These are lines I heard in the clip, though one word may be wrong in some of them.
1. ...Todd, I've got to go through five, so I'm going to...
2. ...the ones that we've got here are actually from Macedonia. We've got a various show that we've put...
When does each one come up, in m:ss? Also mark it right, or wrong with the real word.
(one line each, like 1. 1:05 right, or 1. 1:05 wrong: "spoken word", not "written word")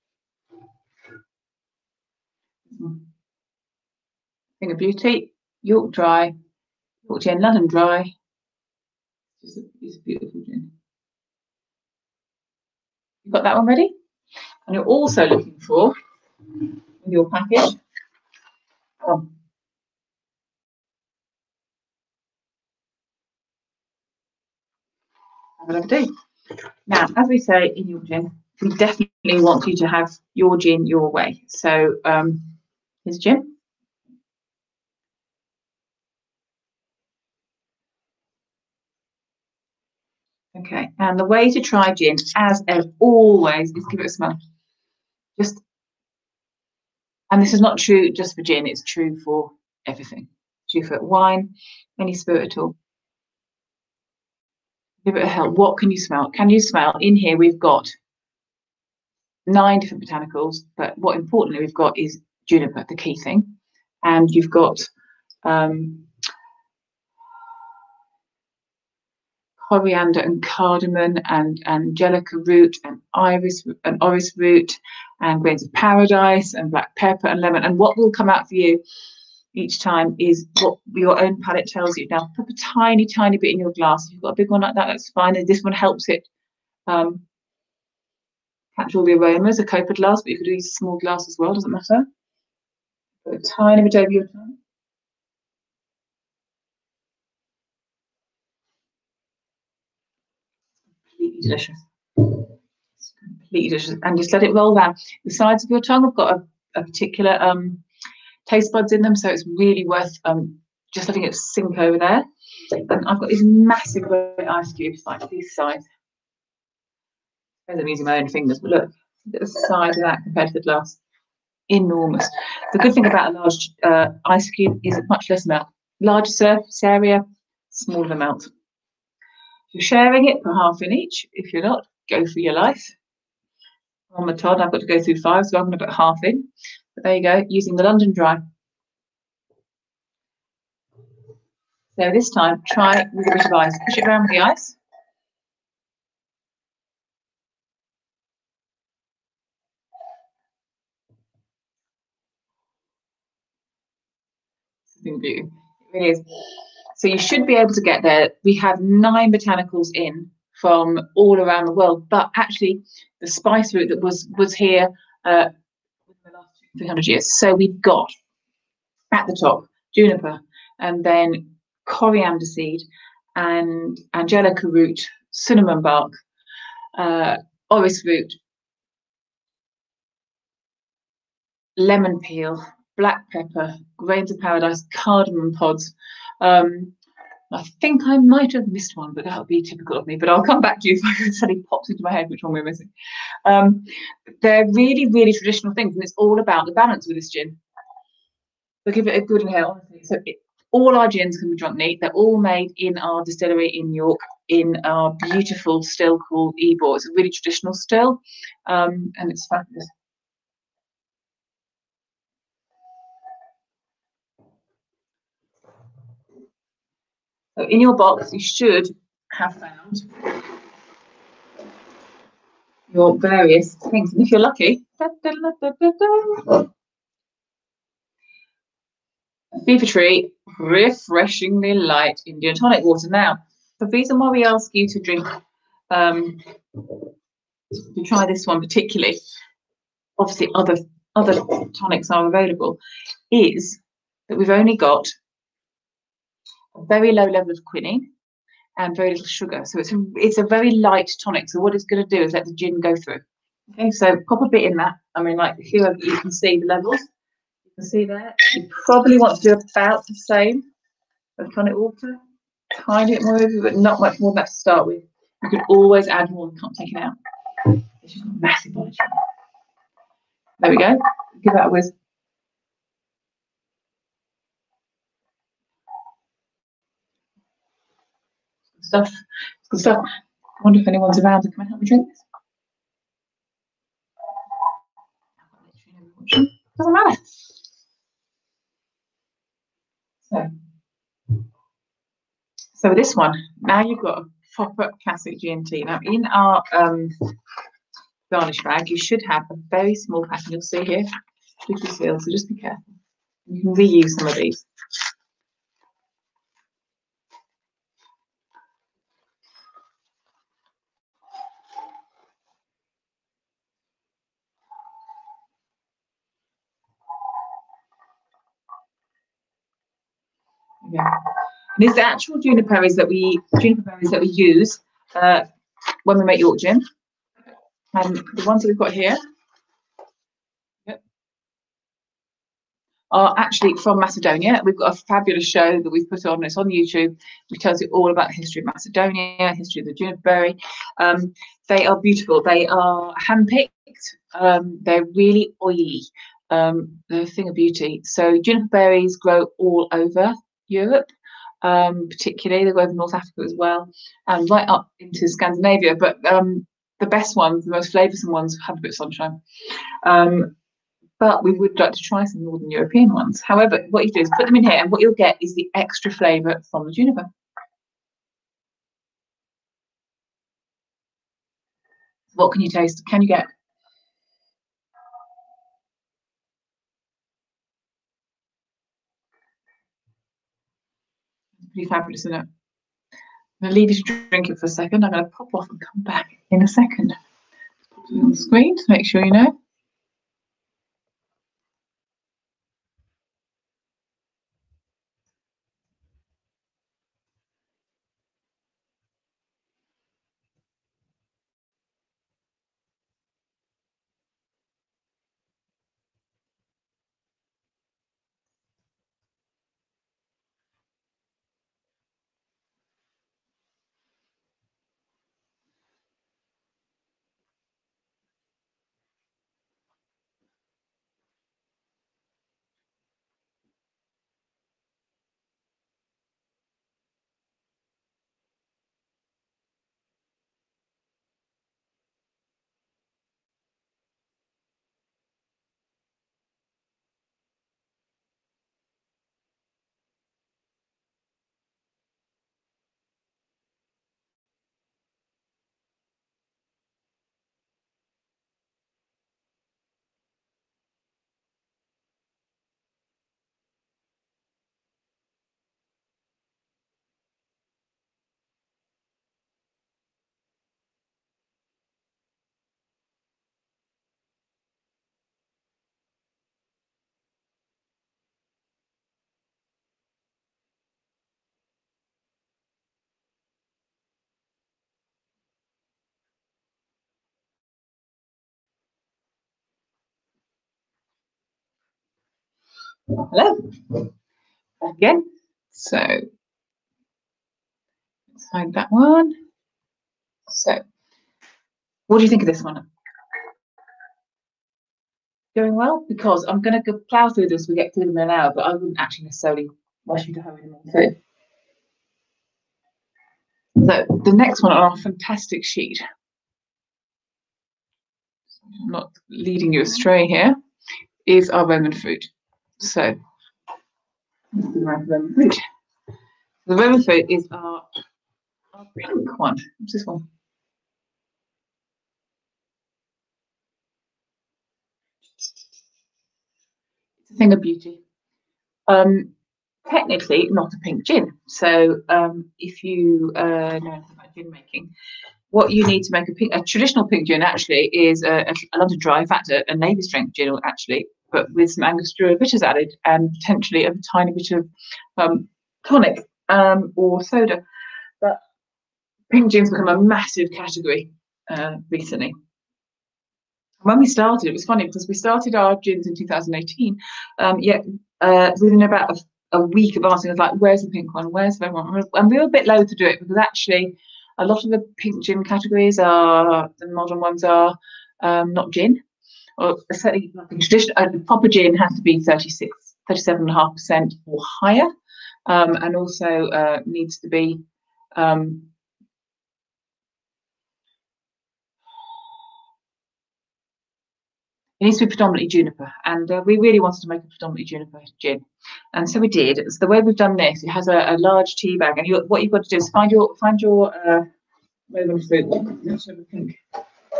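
1. 2:14 right
2. 5:28 wrong: "fabulous", not "various".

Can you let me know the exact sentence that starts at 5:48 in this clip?
So juniper berries grow all over Europe, um, particularly.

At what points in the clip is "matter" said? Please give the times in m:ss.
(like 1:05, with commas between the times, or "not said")
1:31, 4:46.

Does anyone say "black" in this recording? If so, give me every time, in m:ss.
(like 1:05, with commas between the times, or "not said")
1:16, 3:02.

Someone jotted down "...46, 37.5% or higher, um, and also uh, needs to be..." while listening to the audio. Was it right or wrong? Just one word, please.
wrong.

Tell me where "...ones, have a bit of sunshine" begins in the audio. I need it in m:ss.
5:58.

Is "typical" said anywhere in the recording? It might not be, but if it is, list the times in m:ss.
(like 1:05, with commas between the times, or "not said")
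3:09.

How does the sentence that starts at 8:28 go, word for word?
I'm not leading you astray here, is our Roman fruit.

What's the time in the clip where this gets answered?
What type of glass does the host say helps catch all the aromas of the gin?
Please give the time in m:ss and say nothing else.
1:29.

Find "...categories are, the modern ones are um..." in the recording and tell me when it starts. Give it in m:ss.
9:25.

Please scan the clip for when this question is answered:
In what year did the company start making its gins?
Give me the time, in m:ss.
9:16.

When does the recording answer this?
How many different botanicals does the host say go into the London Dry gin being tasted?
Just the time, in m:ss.
0:59.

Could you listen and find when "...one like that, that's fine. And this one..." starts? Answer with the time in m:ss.
1:24.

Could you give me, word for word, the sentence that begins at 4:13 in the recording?
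Okay, so pop a bit in that.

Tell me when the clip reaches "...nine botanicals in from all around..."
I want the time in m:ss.
2:38.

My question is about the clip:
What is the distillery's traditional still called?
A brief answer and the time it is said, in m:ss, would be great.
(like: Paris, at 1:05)
Ebor, at 3:26.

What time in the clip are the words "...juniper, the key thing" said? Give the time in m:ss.
1:02.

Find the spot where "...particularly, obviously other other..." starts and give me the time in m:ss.
3:58.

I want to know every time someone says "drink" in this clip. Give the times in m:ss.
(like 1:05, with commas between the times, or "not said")
3:54, 4:41, 6:24.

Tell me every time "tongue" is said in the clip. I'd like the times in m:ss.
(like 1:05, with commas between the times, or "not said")
1:34, 1:45.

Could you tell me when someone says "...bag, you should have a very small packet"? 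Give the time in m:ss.
4:58.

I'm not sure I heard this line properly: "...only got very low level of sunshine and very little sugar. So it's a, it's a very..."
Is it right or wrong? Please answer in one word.
wrong.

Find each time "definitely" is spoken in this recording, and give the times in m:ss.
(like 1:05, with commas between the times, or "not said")
0:28.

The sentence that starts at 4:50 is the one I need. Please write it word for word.
So, so this one, now you've got a proper classic GMT.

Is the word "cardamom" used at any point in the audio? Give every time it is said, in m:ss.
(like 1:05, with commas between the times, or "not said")
1:10, 3:04.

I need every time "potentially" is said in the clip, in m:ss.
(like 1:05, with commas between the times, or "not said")
9:03.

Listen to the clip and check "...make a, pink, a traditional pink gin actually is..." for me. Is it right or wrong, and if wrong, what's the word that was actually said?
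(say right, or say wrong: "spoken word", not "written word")
right.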